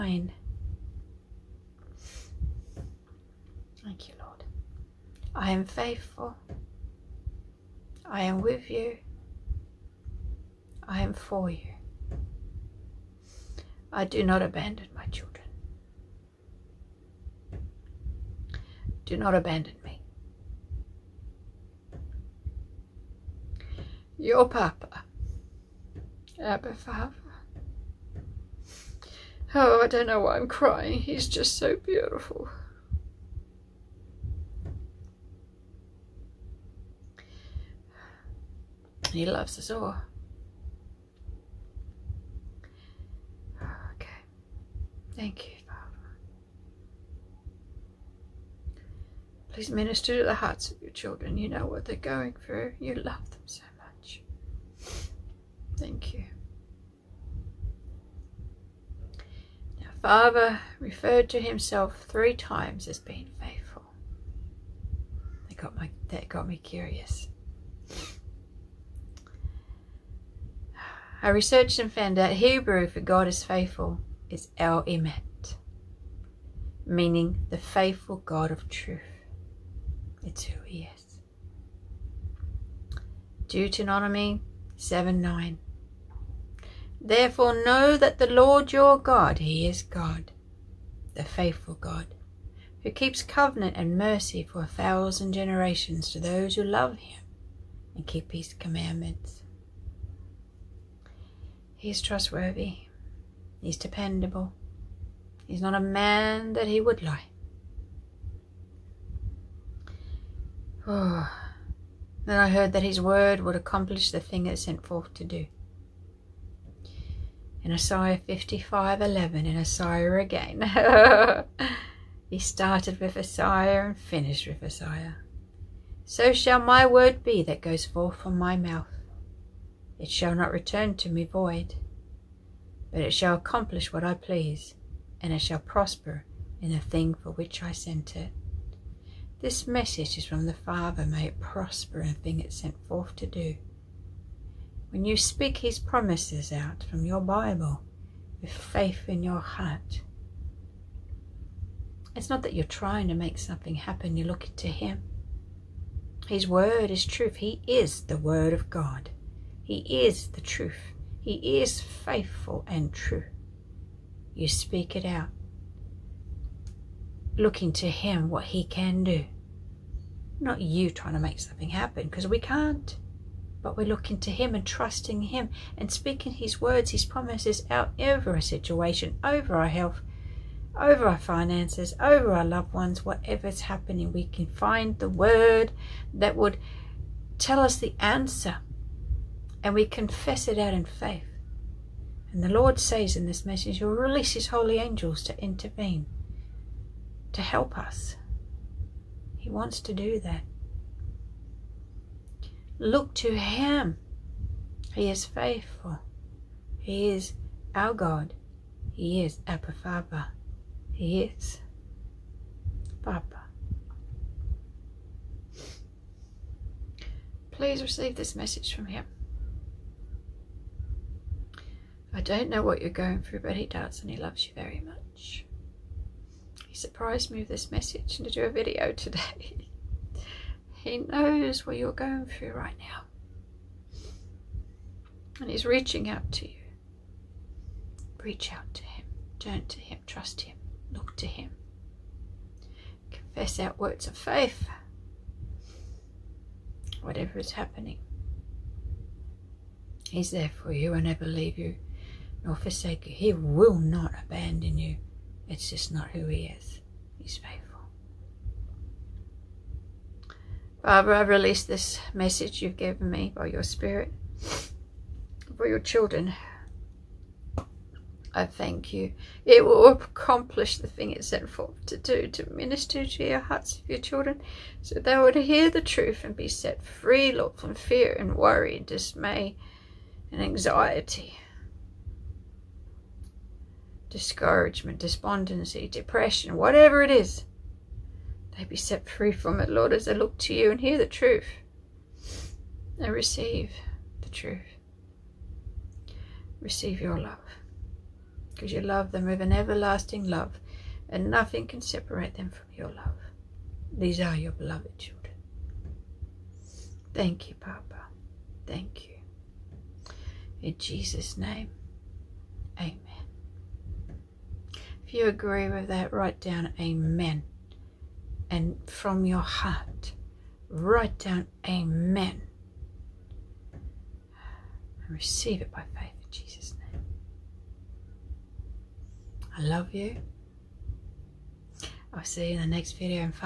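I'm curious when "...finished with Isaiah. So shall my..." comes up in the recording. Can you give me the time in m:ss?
2:03.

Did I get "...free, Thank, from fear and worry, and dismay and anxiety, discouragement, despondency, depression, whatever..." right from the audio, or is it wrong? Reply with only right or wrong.
wrong.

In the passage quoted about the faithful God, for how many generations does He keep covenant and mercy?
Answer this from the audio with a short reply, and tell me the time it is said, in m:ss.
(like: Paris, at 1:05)
1000, at 1:34.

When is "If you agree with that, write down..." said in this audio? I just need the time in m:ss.
5:15.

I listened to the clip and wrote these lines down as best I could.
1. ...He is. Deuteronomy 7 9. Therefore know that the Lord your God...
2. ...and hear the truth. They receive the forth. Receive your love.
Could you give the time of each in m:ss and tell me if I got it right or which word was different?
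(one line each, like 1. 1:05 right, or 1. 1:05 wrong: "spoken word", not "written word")
1. 1:20 right
2. 4:50 wrong: "truth", not "forth".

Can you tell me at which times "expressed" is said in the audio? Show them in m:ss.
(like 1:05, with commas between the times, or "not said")
not said.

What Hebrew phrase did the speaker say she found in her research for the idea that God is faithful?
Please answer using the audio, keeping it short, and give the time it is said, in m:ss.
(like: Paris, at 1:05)
El Emet, at 1:14.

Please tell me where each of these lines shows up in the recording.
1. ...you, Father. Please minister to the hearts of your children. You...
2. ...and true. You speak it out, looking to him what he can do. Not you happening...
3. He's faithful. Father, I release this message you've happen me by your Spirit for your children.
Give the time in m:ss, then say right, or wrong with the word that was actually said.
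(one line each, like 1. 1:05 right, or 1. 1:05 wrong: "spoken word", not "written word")
1. 0:45 right
2. 2:42 wrong: "trying", not "happening"
3. 4:17 wrong: "given", not "happen".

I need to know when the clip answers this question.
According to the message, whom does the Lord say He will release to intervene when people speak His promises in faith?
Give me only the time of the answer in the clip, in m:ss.
3:14.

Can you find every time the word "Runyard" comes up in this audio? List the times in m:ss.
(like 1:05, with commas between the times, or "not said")
not said.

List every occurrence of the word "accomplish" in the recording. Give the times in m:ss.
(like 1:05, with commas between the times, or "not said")
1:53, 2:13, 4:29.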